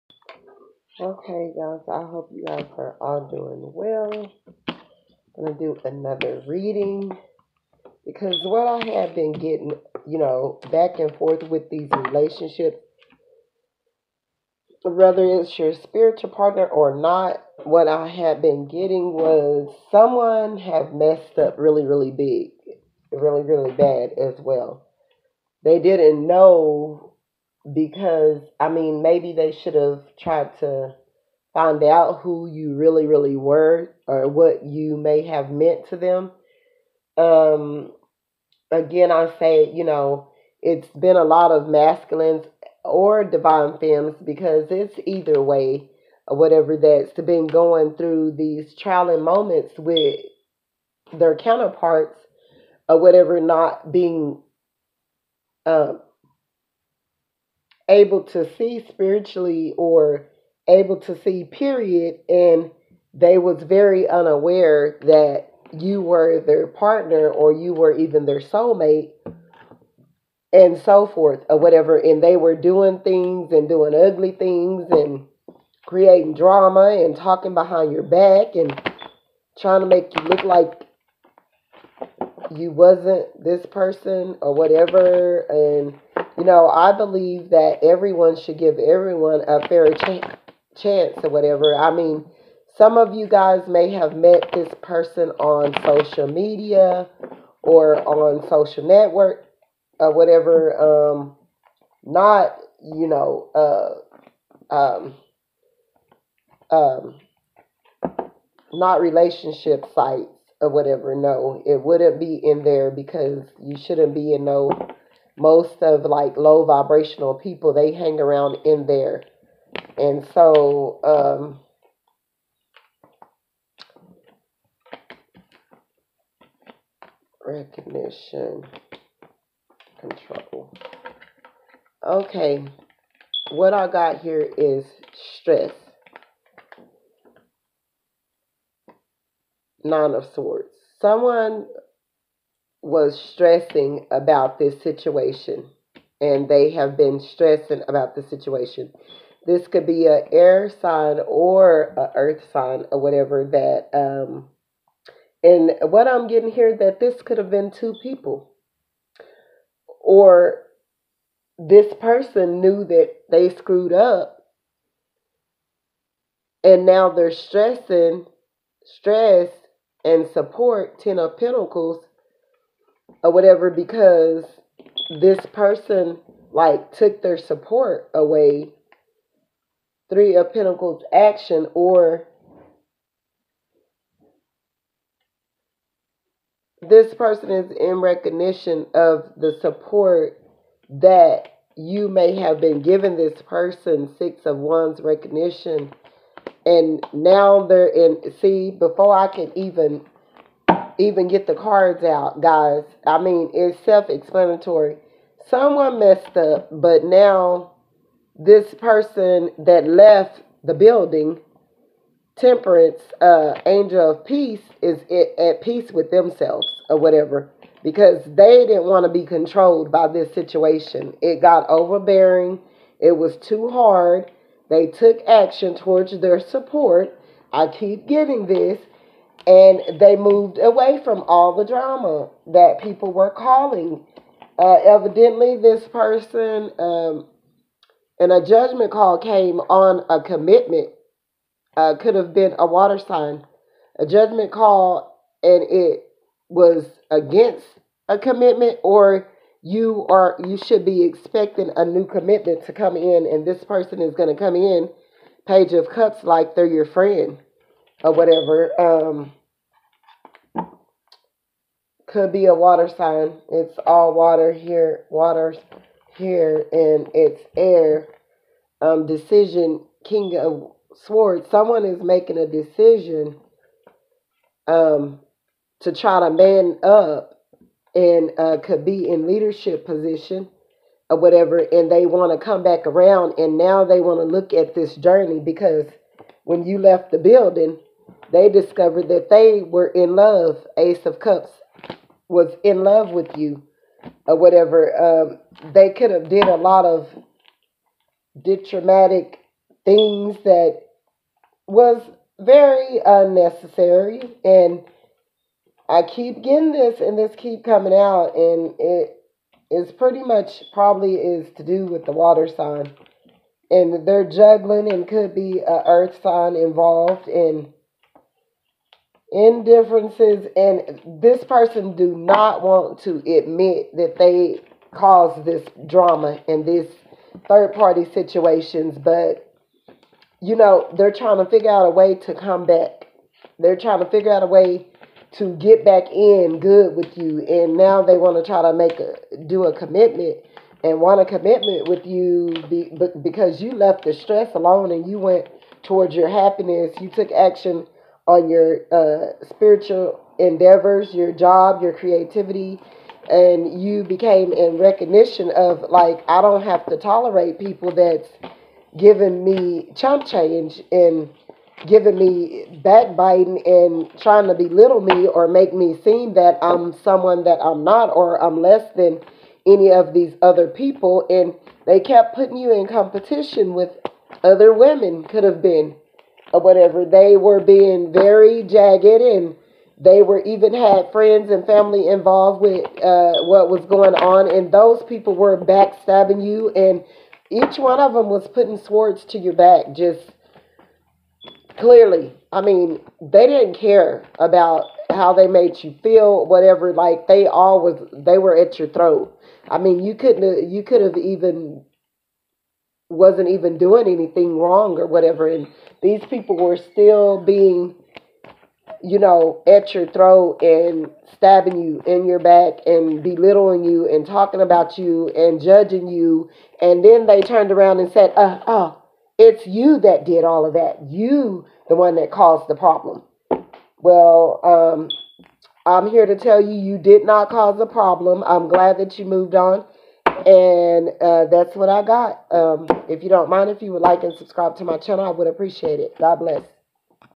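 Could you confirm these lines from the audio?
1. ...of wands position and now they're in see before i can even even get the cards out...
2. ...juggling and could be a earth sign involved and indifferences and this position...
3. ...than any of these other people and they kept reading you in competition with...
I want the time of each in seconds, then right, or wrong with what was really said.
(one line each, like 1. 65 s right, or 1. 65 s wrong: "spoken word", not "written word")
1. 194 s wrong: "recognition", not "position"
2. 314 s wrong: "person", not "position"
3. 368 s wrong: "putting", not "reading".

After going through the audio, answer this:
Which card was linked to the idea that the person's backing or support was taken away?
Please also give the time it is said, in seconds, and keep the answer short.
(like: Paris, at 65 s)
Ten of Pentacles, at 170 s.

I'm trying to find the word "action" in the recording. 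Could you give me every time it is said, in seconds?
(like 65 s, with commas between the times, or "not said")
181 s, 225 s, 347 s.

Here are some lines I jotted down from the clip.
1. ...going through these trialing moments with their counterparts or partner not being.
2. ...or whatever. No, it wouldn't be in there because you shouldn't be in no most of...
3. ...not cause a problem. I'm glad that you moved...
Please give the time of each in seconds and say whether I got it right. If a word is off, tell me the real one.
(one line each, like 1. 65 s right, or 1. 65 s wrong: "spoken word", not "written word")
1. 47 s wrong: "whatever", not "partner"
2. 110 s right
3. 427 s right.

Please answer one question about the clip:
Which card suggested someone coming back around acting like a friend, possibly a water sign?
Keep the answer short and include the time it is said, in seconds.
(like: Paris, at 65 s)
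Page of Cups, at 255 s.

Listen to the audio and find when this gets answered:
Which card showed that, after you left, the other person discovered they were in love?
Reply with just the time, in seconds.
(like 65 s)
290 s.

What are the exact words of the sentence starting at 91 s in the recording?
I mean, some of you guys may have met this person on social media or on social network or whatever.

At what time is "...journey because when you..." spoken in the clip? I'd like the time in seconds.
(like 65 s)
284 s.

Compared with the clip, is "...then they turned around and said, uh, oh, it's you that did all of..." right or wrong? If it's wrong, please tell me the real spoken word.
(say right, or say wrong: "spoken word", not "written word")
right.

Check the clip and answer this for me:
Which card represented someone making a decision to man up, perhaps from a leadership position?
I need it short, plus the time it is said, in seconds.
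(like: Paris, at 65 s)
King of Swords, at 270 s.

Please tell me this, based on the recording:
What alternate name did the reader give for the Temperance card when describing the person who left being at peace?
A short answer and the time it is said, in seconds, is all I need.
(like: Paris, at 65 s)
Angel of Peace, at 213 s.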